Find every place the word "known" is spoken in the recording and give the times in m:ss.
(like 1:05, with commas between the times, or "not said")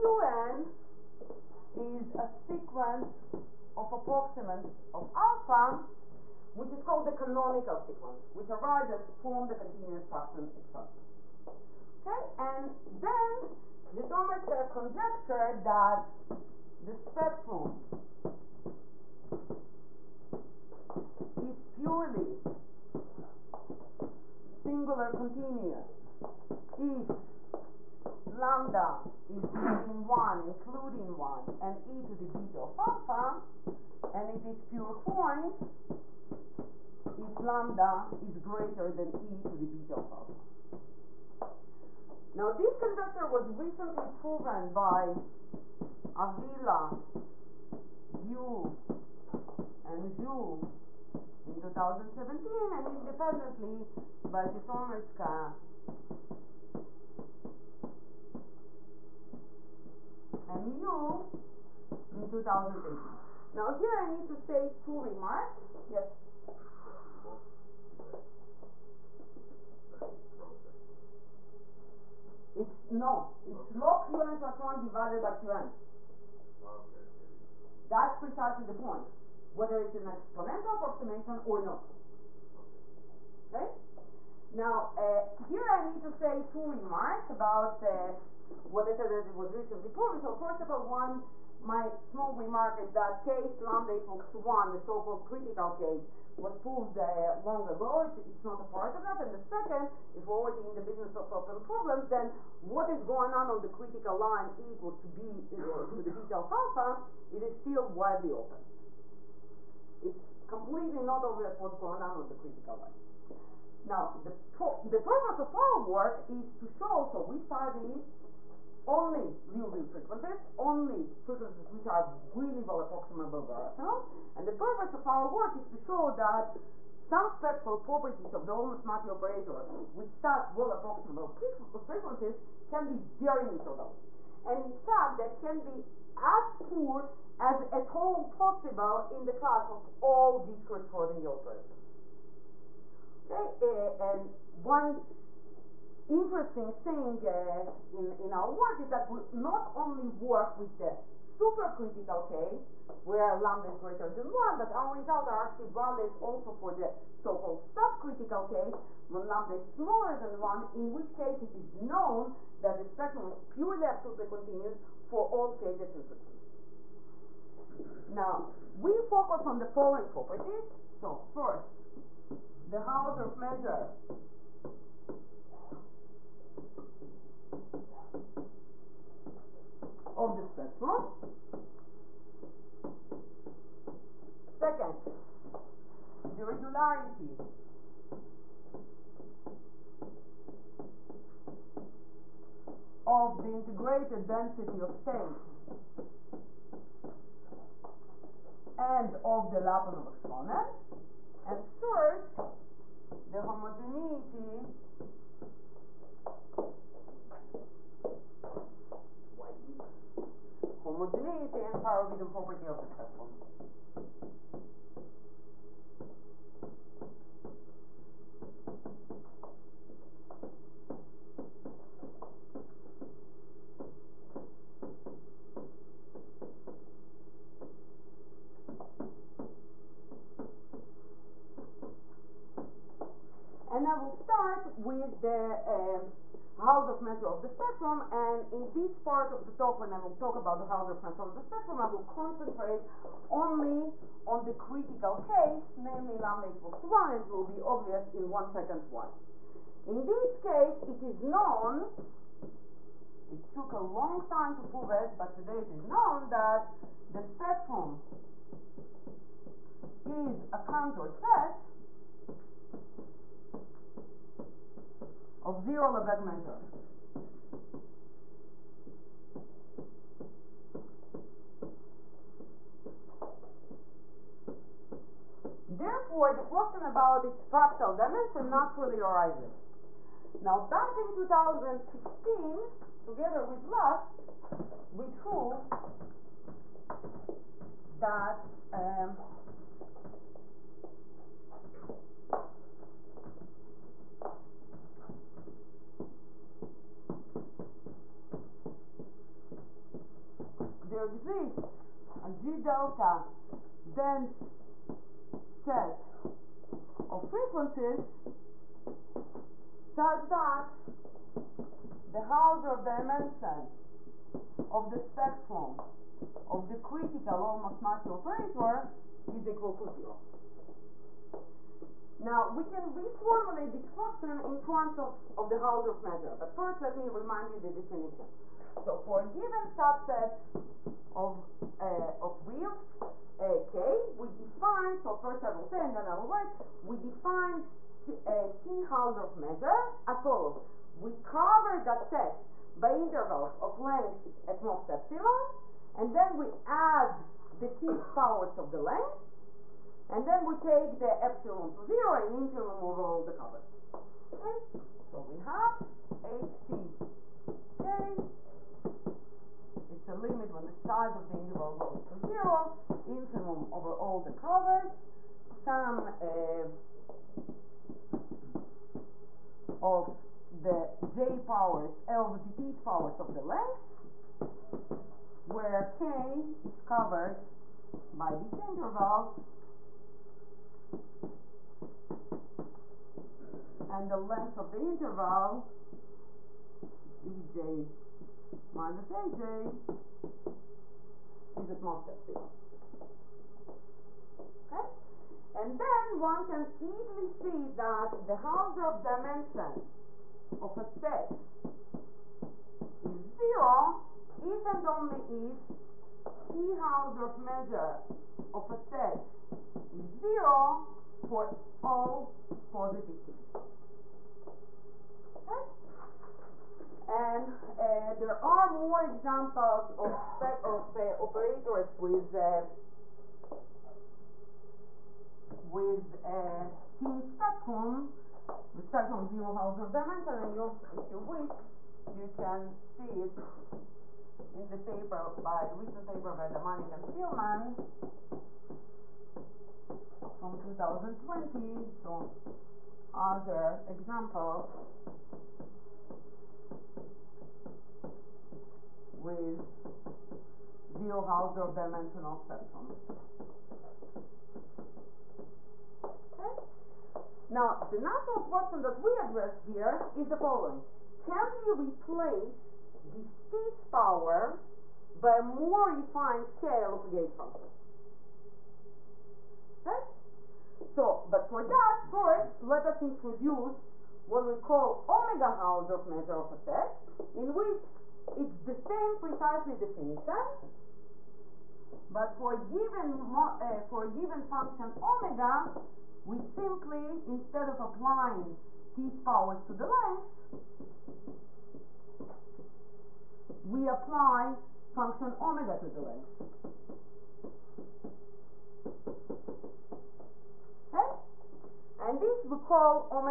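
2:41, 4:11, 4:15.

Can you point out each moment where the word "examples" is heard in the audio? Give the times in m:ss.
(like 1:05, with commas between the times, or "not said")
6:59, 7:23.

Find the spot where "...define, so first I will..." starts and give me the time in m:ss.
5:34.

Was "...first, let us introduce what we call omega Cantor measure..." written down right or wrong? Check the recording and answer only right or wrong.
wrong.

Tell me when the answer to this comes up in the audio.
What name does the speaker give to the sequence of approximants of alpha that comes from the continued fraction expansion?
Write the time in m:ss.
0:07.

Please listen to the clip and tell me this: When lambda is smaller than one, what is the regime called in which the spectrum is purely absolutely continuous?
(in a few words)
subcritical case.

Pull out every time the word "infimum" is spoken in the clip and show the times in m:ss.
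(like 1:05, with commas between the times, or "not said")
5:52, 6:03.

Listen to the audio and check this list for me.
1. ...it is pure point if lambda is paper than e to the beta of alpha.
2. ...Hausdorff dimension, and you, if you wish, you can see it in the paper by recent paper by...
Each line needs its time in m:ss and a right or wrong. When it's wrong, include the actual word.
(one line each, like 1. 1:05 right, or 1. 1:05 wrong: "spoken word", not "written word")
1. 0:34 wrong: "greater", not "paper"
2. 7:09 right.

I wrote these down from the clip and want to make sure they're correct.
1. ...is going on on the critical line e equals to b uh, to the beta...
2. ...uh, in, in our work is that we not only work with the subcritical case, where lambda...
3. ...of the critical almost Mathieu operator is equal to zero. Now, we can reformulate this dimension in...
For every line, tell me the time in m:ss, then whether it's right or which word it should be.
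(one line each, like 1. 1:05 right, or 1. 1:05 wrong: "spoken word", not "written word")
1. 1:42 right
2. 2:27 wrong: "supercritical", not "subcritical"
3. 5:16 wrong: "question", not "dimension".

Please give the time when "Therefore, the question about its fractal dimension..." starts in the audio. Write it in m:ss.
4:35.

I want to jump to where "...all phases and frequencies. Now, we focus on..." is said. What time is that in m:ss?
2:45.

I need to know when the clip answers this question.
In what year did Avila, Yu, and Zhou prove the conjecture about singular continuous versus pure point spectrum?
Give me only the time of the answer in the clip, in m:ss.
0:51.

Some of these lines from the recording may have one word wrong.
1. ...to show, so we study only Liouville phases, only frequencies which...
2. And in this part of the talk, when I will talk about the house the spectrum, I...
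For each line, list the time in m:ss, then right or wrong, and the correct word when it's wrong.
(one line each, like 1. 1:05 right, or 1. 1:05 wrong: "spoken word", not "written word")
1. 1:56 wrong: "frequencies", not "phases"
2. 3:58 right.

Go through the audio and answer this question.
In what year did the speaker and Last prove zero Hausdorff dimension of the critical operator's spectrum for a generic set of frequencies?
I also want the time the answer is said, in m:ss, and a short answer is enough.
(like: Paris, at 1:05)
2016, at 4:41.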